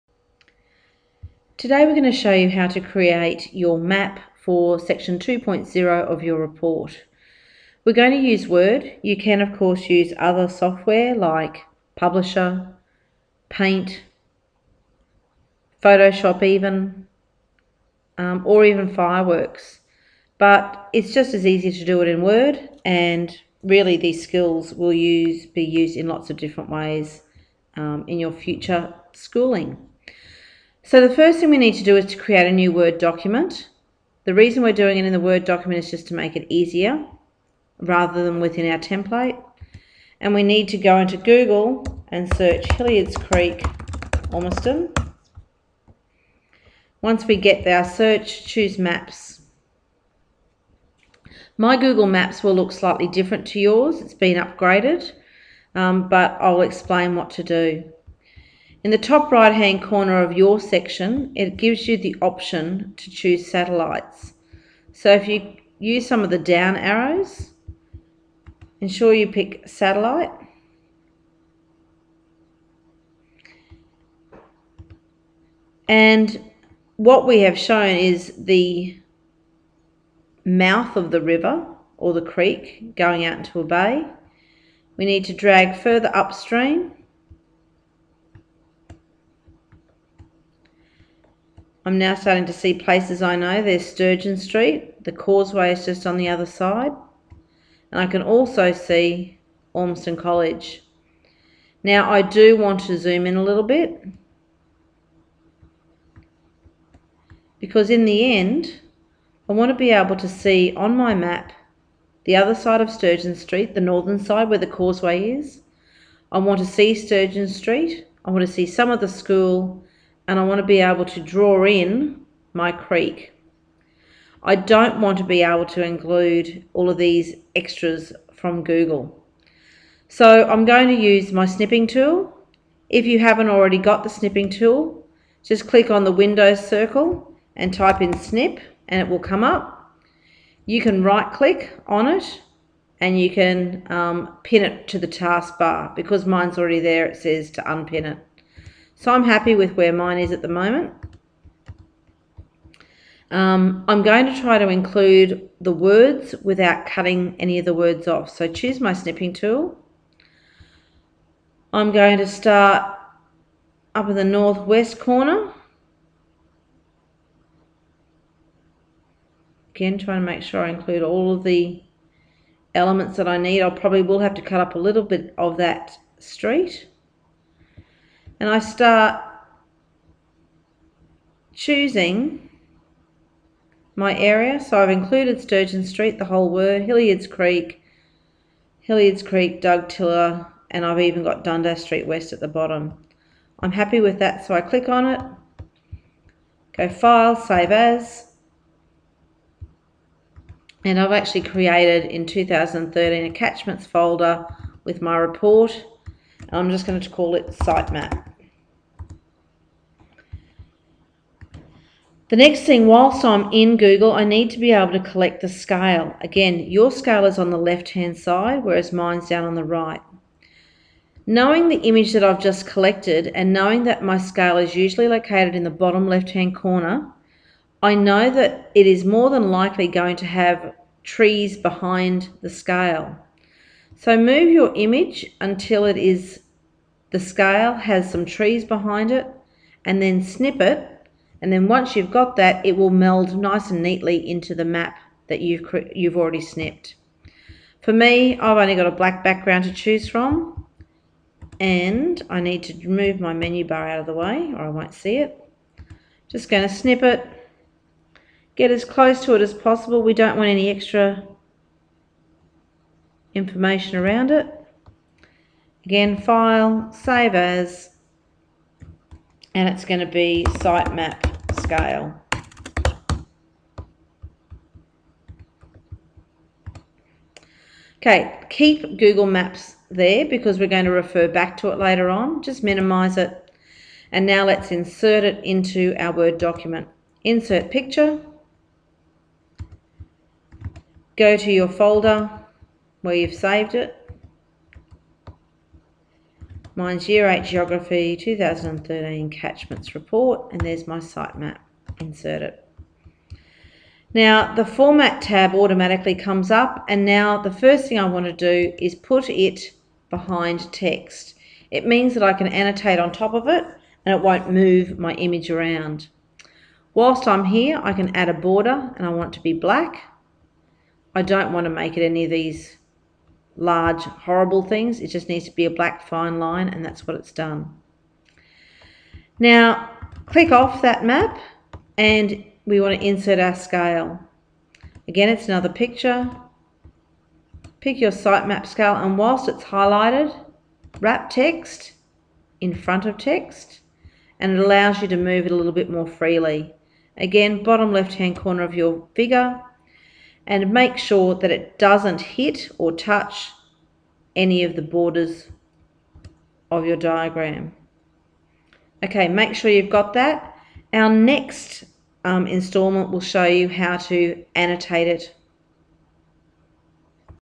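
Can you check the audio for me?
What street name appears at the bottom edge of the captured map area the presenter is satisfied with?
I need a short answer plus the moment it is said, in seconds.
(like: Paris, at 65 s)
Dundas Street West, at 191 s.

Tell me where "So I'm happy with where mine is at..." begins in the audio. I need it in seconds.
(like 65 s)
149 s.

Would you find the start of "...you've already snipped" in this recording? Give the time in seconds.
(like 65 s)
245 s.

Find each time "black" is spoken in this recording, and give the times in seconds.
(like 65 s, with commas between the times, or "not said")
248 s, 319 s, 325 s.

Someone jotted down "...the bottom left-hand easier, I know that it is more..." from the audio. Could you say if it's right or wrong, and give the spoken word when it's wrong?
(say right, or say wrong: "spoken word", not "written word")
wrong: "corner", not "easier".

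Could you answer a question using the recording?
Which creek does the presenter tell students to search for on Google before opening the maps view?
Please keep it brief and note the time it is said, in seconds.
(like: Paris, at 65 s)
Hilliards Creek, at 42 s.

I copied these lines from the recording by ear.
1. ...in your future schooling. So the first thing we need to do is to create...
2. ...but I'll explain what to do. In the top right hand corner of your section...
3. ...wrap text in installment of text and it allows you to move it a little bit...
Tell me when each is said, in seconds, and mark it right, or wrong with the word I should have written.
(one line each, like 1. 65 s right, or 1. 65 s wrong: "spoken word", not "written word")
1. 28 s right
2. 56 s right
3. 340 s wrong: "front", not "installment".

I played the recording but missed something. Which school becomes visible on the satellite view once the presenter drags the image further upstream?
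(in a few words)
Ormiston College.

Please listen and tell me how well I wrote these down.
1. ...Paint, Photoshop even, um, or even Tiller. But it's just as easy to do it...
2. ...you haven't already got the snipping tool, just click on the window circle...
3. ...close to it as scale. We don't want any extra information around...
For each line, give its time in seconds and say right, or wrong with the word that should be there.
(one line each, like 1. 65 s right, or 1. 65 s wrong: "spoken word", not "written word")
1. 13 s wrong: "Fireworks", not "Tiller"
2. 133 s right
3. 258 s wrong: "possible", not "scale".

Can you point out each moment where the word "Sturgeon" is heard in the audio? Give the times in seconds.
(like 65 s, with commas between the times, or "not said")
93 s, 112 s, 116 s, 185 s.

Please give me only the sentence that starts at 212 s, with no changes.
The next thing, whilst I'm in Google, I need to be able to collect the scale.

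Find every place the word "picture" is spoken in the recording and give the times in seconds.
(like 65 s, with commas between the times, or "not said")
287 s, 335 s.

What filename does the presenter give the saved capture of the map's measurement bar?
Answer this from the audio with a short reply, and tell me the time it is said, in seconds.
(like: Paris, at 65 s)
Sitemap scale, at 270 s.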